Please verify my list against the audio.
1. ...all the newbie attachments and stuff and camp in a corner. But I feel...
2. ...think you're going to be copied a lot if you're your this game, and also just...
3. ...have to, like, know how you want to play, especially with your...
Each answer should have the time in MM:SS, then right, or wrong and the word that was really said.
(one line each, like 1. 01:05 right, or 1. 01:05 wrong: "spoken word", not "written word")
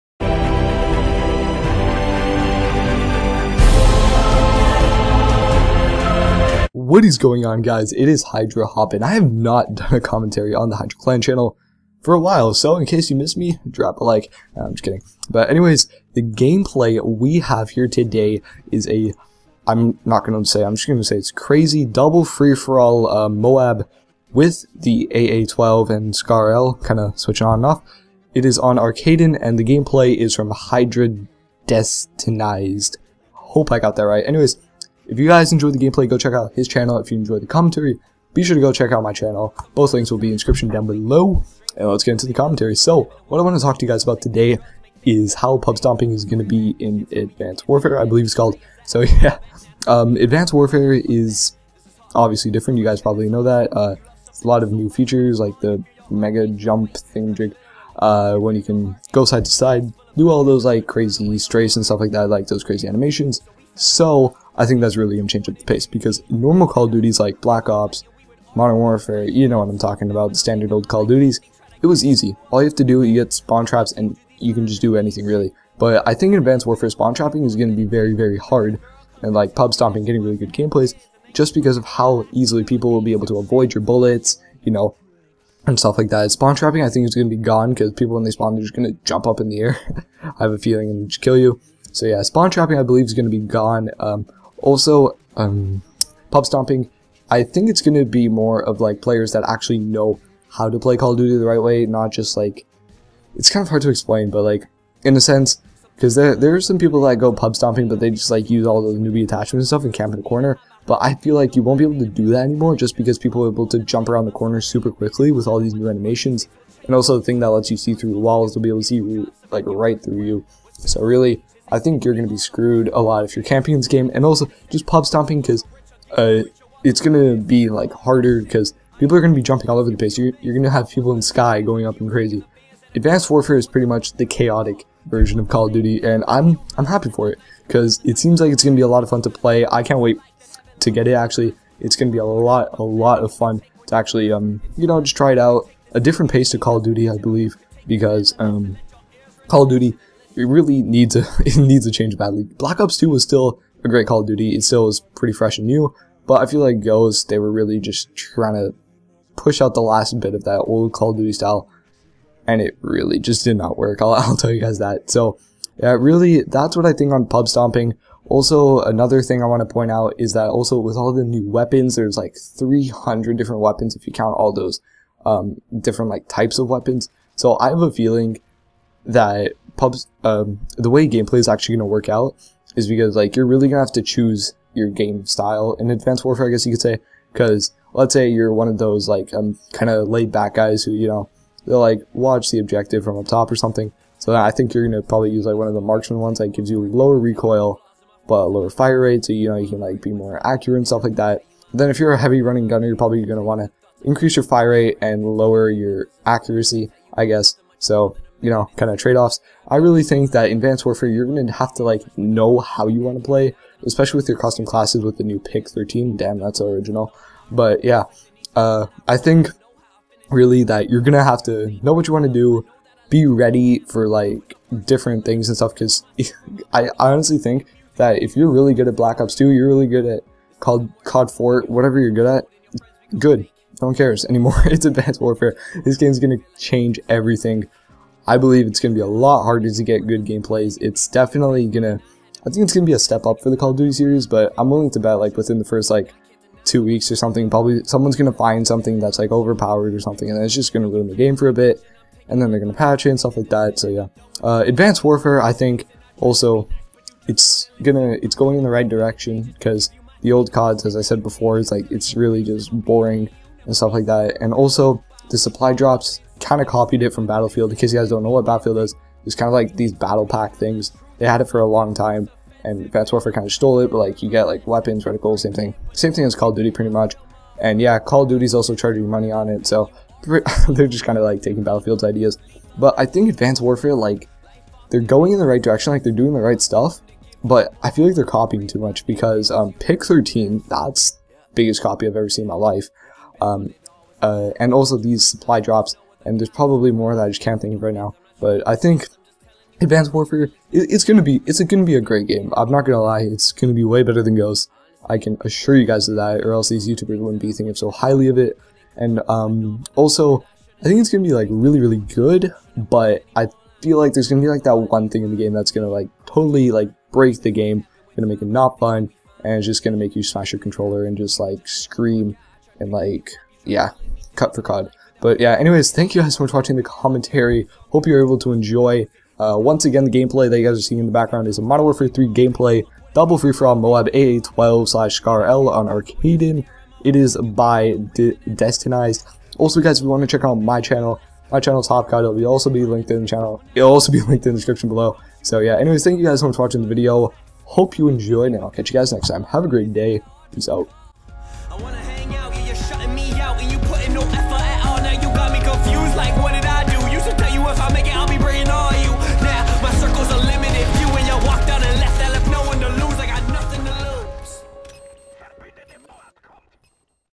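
1. 01:48 right
2. 02:01 wrong: "screwed", not "copied"
3. 03:31 right.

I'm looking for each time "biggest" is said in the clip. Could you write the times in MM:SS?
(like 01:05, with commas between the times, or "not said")
04:51.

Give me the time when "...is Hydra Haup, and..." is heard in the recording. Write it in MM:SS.
00:08.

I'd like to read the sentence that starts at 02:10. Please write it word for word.
You're, you're going to have people in sky going up and crazy.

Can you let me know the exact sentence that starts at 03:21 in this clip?
Then if you're a heavy running gunner, you're probably gonna want to increase your fire rate and lower your accuracy, I guess.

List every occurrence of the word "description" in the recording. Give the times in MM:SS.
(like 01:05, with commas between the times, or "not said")
00:40, 05:44.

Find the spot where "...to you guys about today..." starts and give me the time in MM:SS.
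00:43.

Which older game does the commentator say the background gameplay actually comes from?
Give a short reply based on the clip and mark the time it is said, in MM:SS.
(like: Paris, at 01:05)
Modern Warfare 3, at 05:31.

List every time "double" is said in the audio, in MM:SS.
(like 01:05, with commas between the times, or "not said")
00:21, 05:33.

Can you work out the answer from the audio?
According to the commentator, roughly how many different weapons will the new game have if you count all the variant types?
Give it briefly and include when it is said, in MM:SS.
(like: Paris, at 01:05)
300, at 02:52.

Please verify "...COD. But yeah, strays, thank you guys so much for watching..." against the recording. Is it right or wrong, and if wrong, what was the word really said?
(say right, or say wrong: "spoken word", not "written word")
wrong: "anyways", not "strays".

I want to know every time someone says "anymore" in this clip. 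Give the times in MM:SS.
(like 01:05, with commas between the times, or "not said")
01:52, 03:54.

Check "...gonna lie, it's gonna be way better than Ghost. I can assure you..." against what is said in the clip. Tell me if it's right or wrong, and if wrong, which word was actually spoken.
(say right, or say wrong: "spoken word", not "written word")
right.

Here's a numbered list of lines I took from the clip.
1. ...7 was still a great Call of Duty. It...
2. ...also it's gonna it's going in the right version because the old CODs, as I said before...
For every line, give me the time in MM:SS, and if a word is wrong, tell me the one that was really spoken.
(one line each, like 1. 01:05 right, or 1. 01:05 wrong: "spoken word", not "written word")
1. 02:32 wrong: "2", not "7"
2. 04:16 wrong: "direction", not "version".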